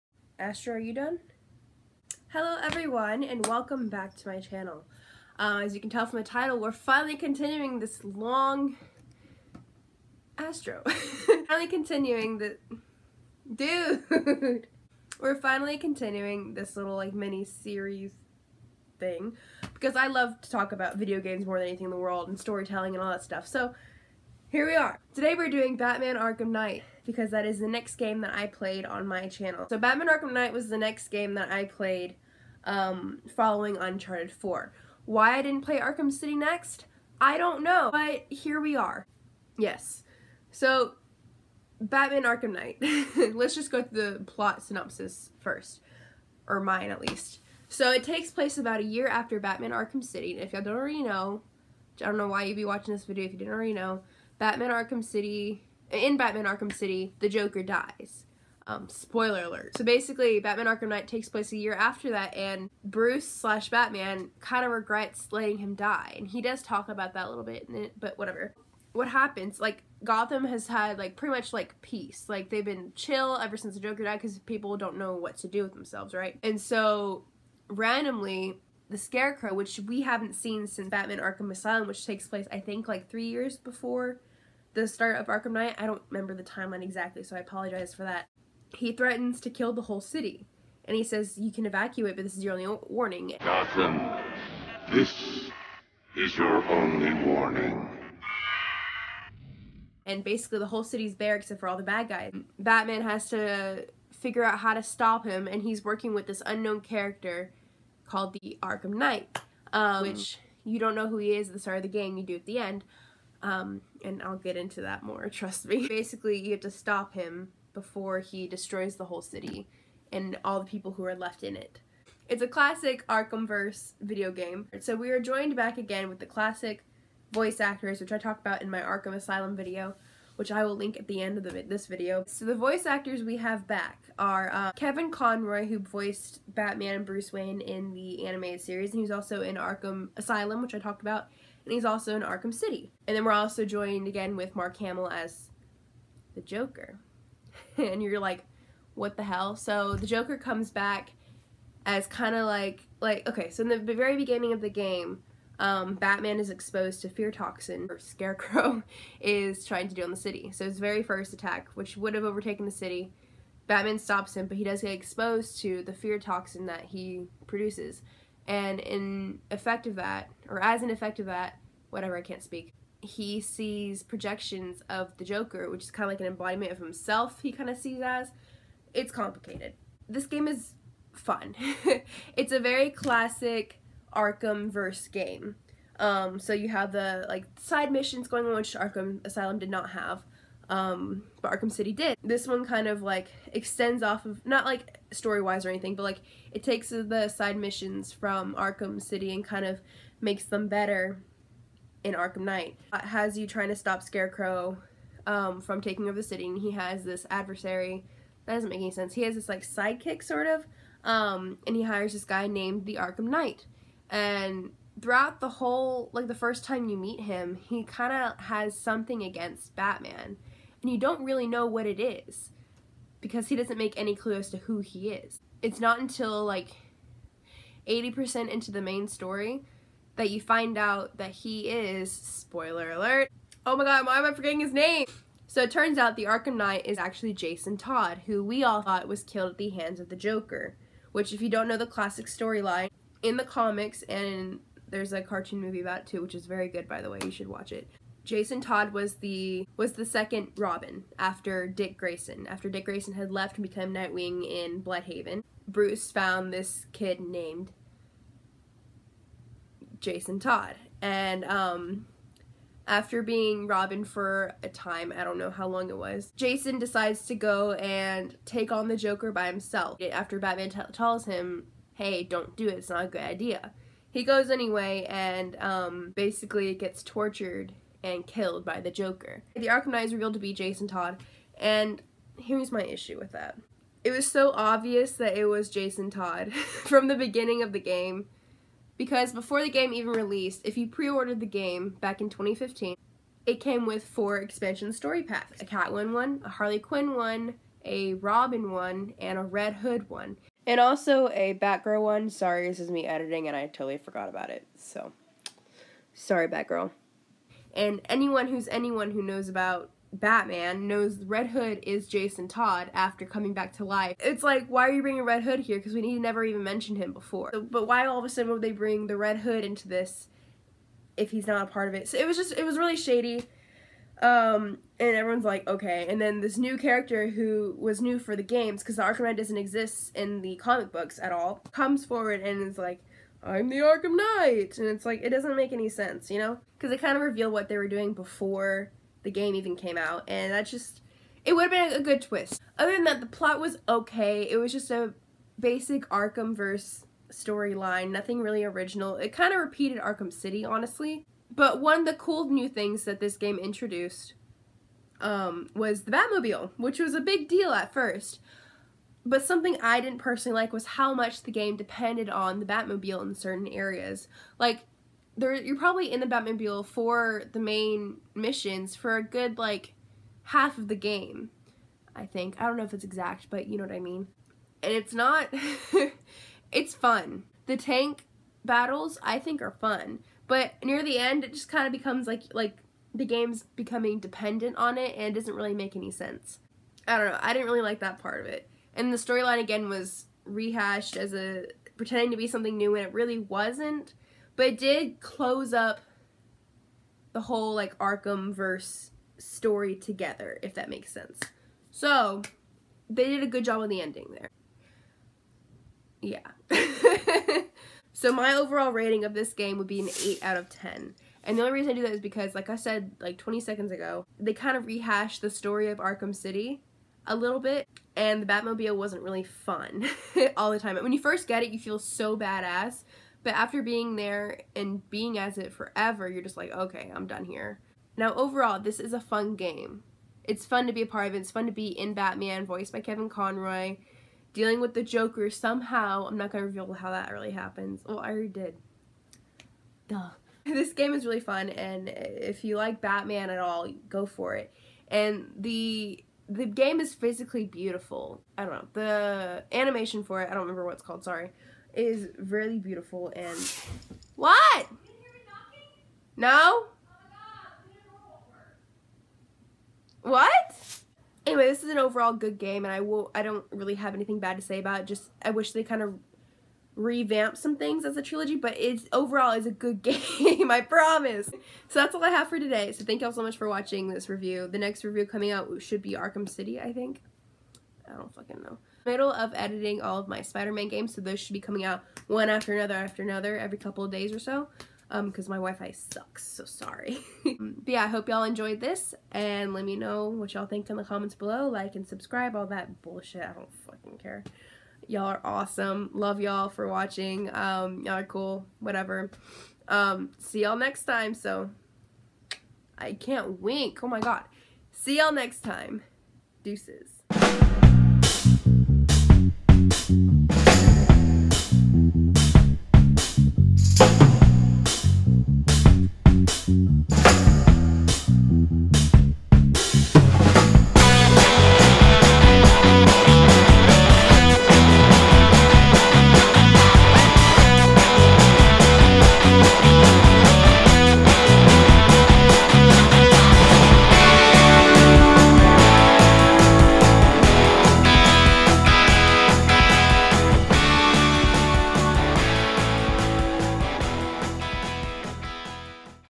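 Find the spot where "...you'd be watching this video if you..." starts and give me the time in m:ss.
0:52.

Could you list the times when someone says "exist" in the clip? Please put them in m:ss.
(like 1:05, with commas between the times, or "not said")
5:29.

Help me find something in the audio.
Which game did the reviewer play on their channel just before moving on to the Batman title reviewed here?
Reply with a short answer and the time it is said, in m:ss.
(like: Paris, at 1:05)
Uncharted 4, at 0:33.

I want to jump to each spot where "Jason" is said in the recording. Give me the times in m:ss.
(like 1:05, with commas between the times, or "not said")
3:57, 4:08, 4:19, 4:26, 4:40, 4:45, 5:12.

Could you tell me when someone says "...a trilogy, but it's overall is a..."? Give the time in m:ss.
7:48.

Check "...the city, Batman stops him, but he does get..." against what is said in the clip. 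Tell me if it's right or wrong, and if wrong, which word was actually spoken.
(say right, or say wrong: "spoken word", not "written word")
right.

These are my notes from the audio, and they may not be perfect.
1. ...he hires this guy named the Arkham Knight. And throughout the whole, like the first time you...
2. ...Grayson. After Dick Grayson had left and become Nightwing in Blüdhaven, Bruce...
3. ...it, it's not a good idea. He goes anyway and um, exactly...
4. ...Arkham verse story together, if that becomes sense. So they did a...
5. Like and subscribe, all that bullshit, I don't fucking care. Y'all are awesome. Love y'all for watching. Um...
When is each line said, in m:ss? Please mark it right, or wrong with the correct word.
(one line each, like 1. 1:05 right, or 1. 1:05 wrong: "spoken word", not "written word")
1. 3:31 right
2. 4:11 right
3. 4:32 wrong: "basically", not "exactly"
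4. 6:37 wrong: "makes", not "becomes"
5. 8:11 right.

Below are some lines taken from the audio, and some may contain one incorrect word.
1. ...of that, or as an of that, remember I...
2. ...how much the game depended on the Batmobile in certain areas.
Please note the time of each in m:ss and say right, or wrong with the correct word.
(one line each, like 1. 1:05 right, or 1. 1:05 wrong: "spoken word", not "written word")
1. 2:49 wrong: "whatever", not "remember"
2. 6:00 right.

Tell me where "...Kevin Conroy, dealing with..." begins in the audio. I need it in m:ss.
7:13.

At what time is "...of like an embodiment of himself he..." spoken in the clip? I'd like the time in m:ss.
2:56.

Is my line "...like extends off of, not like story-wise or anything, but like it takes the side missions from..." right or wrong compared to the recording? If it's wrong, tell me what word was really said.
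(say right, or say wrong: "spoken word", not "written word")
right.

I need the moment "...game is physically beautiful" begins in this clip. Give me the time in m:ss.
7:26.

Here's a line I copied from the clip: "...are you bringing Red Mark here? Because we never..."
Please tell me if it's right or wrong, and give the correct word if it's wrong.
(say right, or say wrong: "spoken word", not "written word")
wrong: "Hood", not "Mark".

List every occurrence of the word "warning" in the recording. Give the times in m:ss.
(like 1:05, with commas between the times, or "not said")
1:32, 1:37.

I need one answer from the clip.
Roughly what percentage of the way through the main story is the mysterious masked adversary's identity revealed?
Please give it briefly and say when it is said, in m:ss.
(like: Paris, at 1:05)
80%, at 3:47.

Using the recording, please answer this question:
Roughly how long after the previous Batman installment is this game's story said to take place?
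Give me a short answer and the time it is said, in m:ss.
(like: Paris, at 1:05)
about a year, at 0:48.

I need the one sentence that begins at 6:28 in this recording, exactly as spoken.
And the storyline again was rehashed as a pretending to be something new and it really wasn't.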